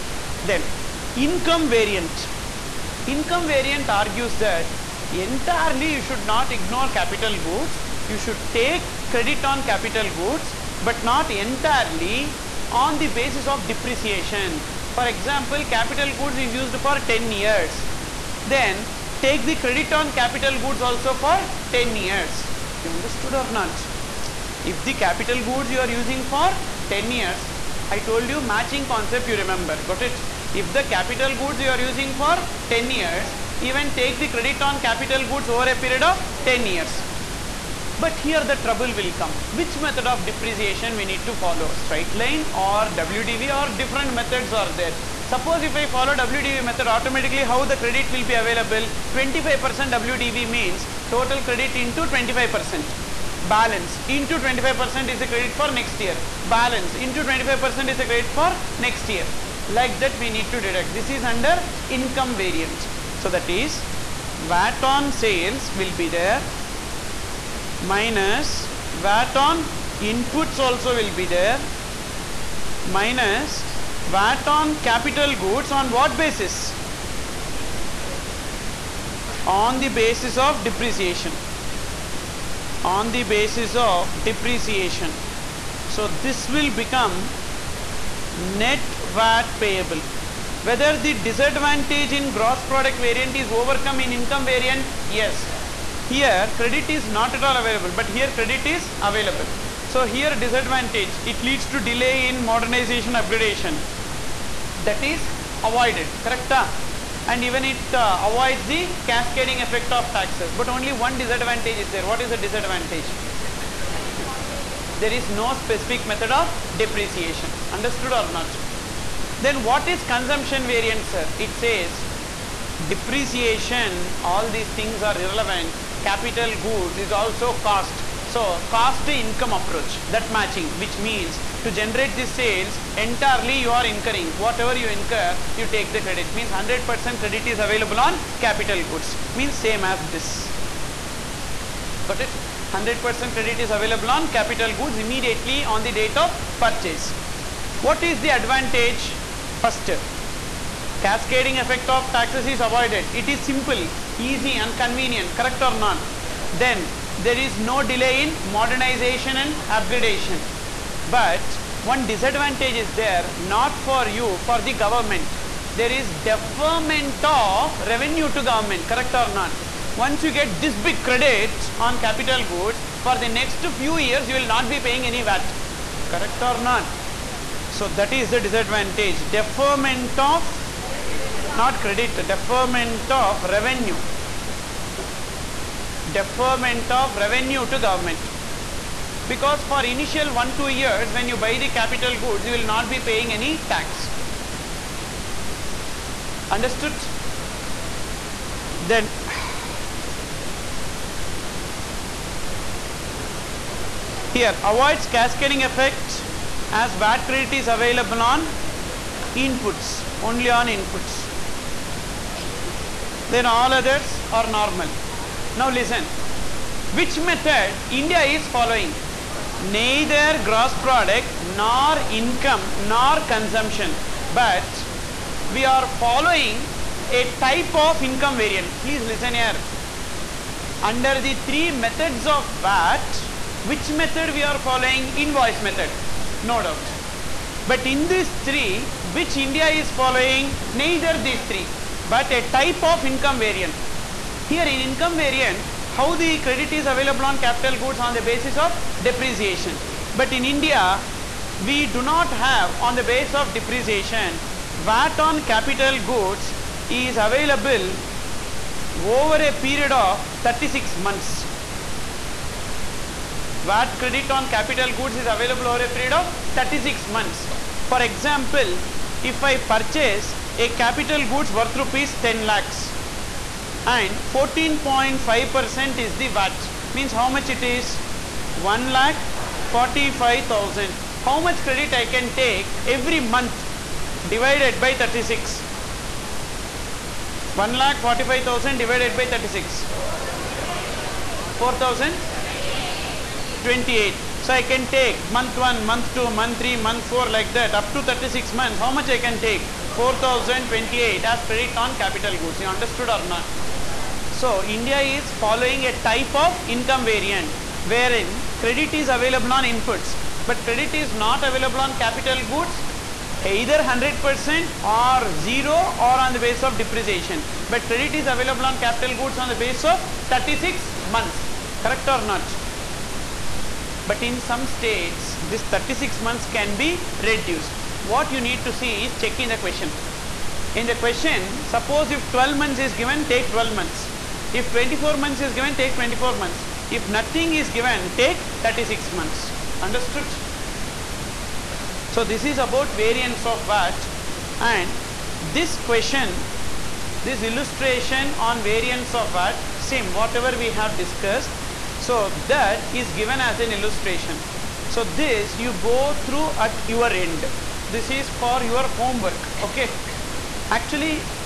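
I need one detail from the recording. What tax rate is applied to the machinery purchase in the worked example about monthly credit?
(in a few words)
14.5%.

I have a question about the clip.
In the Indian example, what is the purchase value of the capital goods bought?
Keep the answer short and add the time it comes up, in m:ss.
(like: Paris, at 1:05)
10 lakhs, at 4:31.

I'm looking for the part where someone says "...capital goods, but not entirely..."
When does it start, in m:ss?
0:09.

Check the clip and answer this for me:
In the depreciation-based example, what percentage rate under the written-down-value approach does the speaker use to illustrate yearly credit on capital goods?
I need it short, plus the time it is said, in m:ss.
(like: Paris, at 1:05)
25%, at 0:49.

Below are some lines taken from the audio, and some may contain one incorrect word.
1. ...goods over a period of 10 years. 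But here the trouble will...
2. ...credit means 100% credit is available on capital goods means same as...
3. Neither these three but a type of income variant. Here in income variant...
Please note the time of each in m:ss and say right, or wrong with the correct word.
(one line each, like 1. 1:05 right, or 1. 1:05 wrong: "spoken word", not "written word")
1. 0:35 right
2. 2:16 right
3. 4:00 right.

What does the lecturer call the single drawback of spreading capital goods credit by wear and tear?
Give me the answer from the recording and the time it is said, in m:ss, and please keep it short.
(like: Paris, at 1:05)
No specific method of depreciation, at 1:54.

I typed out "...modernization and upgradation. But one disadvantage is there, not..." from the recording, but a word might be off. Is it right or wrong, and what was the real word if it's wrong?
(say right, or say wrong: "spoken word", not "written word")
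right.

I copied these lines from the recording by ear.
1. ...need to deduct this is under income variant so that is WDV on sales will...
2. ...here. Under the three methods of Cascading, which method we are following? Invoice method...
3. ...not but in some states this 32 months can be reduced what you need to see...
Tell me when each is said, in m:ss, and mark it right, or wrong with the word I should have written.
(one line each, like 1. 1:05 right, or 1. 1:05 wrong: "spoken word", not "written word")
1. 1:00 wrong: "VAT", not "WDV"
2. 3:49 wrong: "VAT", not "Cascading"
3. 5:22 wrong: "36", not "32".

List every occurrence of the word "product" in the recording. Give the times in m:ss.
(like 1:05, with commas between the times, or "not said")
1:32, 3:40.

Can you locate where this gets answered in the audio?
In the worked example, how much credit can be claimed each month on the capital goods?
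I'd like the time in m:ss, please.
4:59.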